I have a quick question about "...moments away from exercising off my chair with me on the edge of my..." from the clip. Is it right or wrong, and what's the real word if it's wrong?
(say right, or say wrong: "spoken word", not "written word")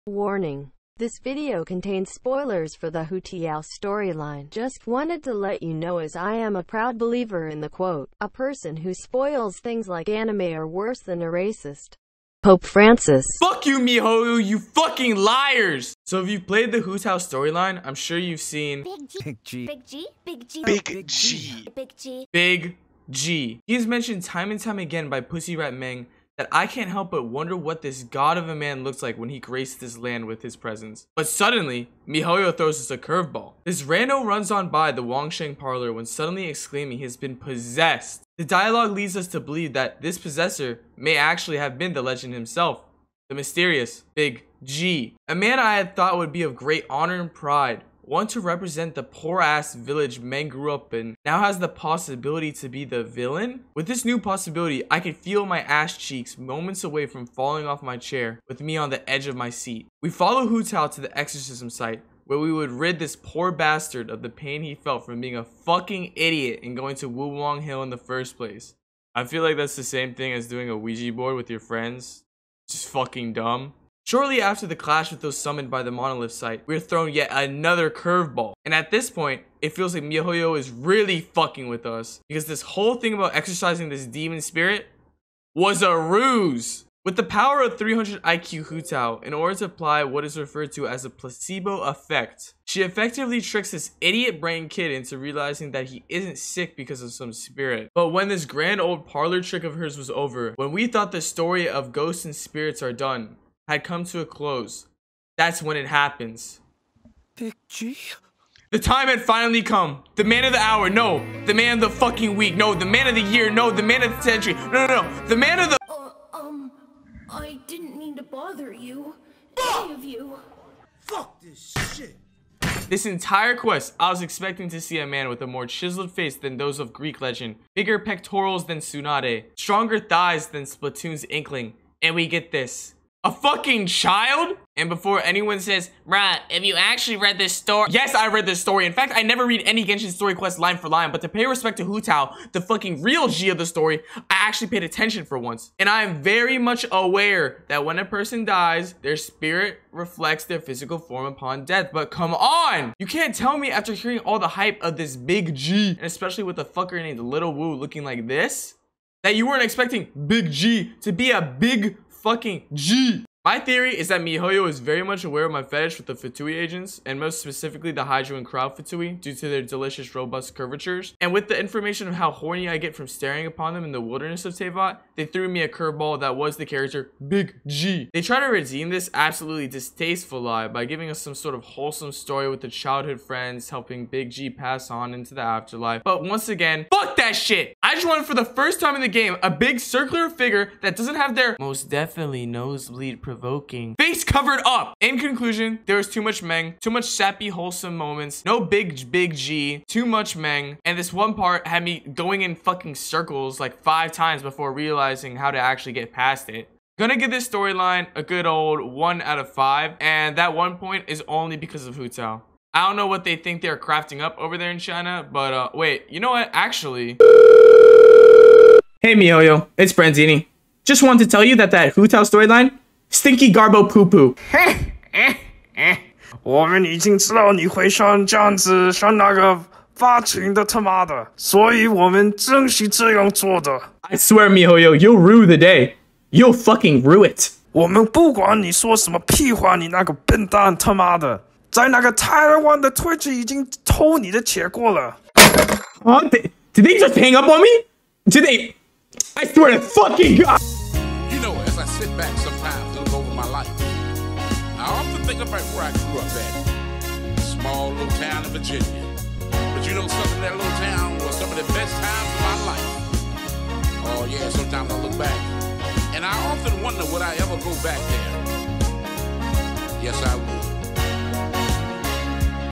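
wrong: "falling", not "exercising".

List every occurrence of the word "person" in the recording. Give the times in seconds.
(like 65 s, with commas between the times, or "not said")
8 s, 148 s.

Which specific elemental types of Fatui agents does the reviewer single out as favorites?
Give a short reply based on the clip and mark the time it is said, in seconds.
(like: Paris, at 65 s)
Hydro and Cryo, at 168 s.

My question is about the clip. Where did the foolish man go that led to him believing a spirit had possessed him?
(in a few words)
Wuwang Hill.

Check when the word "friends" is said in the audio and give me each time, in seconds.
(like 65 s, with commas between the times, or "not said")
71 s, 183 s.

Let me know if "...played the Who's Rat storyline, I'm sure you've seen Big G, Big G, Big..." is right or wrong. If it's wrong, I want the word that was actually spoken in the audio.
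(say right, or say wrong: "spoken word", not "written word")
wrong: "House", not "Rat".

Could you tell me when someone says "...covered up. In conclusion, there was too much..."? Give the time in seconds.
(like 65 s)
194 s.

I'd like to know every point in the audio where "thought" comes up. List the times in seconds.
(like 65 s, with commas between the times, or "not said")
45 s, 100 s.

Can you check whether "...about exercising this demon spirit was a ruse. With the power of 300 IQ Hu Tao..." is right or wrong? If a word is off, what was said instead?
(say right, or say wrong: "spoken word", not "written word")
right.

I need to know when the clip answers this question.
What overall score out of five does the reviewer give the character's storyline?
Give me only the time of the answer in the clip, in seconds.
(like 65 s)
208 s.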